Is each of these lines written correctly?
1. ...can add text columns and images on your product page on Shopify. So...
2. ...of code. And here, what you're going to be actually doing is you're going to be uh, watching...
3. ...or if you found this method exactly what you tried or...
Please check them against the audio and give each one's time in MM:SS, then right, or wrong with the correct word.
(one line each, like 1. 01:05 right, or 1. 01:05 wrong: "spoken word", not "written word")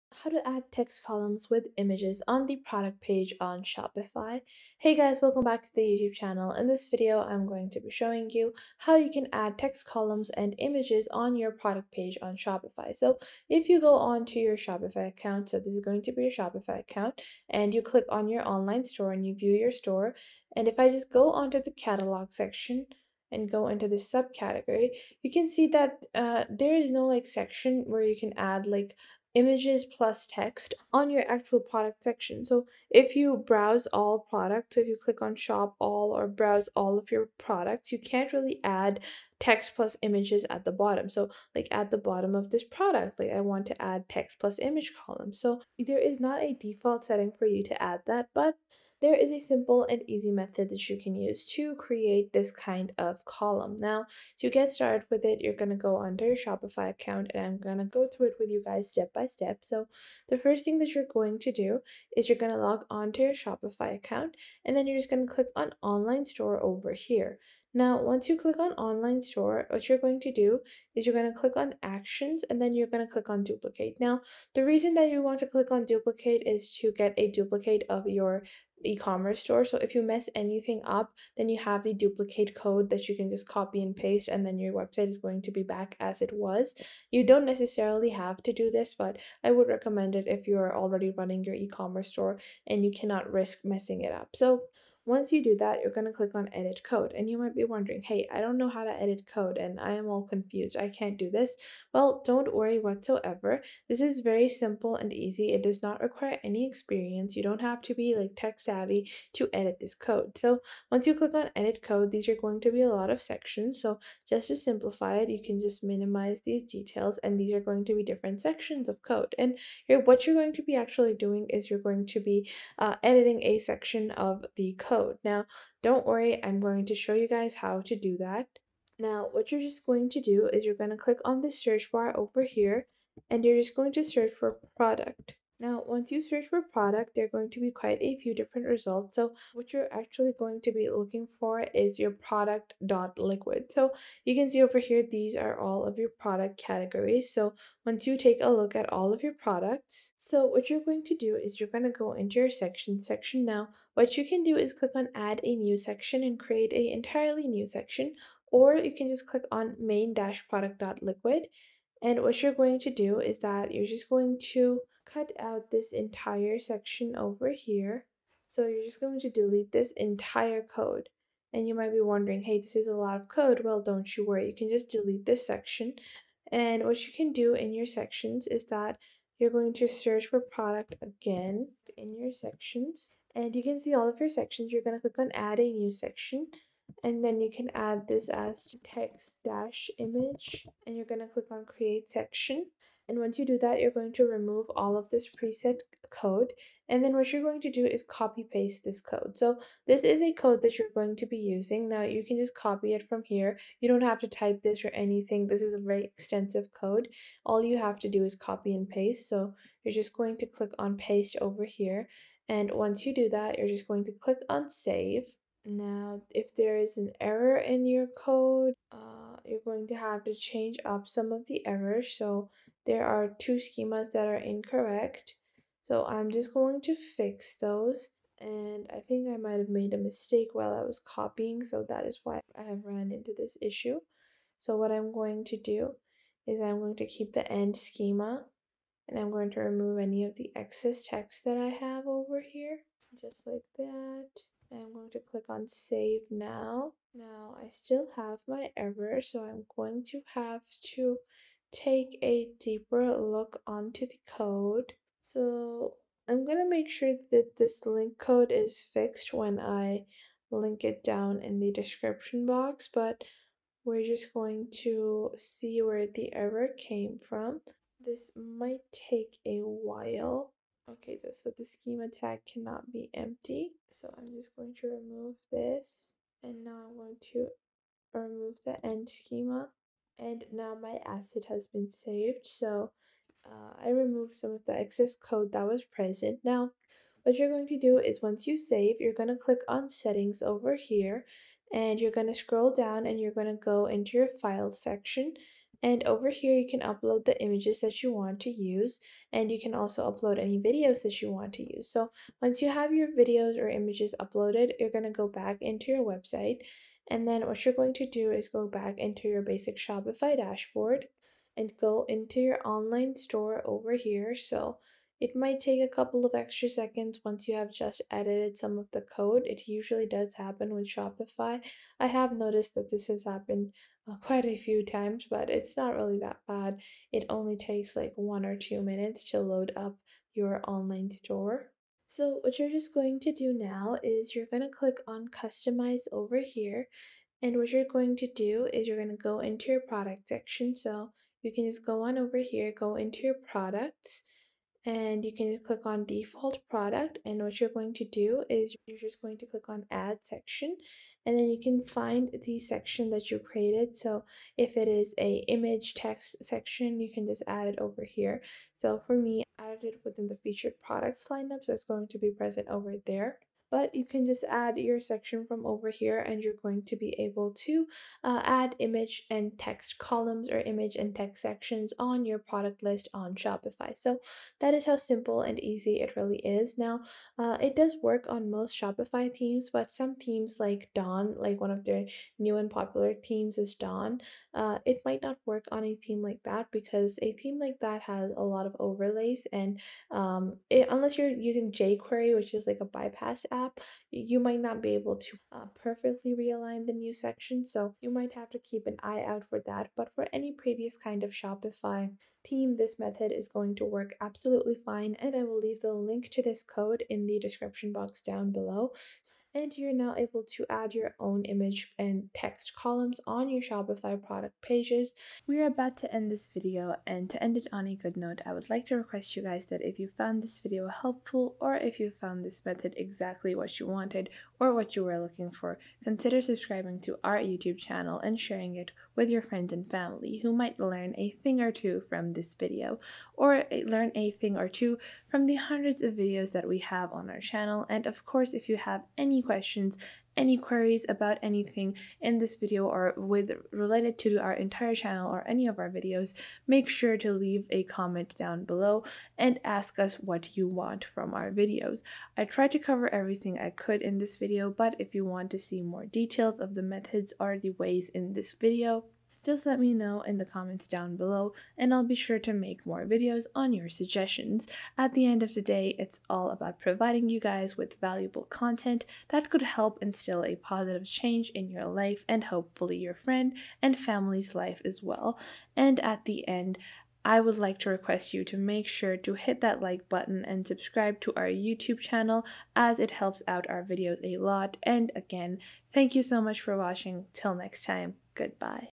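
1. 00:09 right
2. 01:58 wrong: "editing", not "watching"
3. 07:01 wrong: "wanted", not "tried".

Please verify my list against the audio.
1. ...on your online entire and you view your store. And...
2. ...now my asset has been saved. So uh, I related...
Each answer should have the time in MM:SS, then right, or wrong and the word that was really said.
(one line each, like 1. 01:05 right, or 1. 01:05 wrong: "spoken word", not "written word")
1. 00:18 wrong: "store", not "entire"
2. 04:40 wrong: "removed", not "related".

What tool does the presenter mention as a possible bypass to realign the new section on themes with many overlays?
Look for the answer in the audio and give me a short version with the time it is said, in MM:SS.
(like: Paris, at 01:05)
jQuery, at 06:31.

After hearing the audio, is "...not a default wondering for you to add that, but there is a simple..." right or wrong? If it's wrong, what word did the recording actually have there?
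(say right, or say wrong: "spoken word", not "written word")
wrong: "setting", not "wondering".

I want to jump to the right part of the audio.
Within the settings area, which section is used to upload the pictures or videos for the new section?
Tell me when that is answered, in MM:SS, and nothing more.
04:54.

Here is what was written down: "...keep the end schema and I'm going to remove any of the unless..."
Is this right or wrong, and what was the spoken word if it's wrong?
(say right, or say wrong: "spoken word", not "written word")
wrong: "excess", not "unless".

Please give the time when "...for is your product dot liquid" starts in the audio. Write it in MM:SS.
02:21.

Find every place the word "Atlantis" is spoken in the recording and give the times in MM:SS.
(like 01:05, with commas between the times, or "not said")
not said.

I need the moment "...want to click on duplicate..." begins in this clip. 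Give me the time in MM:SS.
01:15.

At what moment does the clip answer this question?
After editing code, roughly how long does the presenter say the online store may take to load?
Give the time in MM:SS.
05:28.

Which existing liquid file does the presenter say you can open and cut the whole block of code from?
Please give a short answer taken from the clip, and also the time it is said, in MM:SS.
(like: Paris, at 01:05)
main-product.liquid, at 02:39.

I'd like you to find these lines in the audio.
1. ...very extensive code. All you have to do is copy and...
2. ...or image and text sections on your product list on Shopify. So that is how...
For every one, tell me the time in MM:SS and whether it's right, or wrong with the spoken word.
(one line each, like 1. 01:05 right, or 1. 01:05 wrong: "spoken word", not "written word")
1. 03:25 right
2. 06:10 right.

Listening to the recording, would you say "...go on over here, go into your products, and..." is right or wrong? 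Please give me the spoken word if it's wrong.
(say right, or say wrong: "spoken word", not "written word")
right.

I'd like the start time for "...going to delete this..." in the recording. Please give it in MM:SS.
02:49.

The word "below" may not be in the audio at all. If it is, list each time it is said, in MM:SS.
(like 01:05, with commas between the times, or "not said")
06:48, 07:28, 07:41.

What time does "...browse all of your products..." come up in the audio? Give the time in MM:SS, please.
00:36.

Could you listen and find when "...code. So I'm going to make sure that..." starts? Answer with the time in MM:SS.
04:14.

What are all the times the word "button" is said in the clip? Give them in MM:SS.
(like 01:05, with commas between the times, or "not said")
08:00.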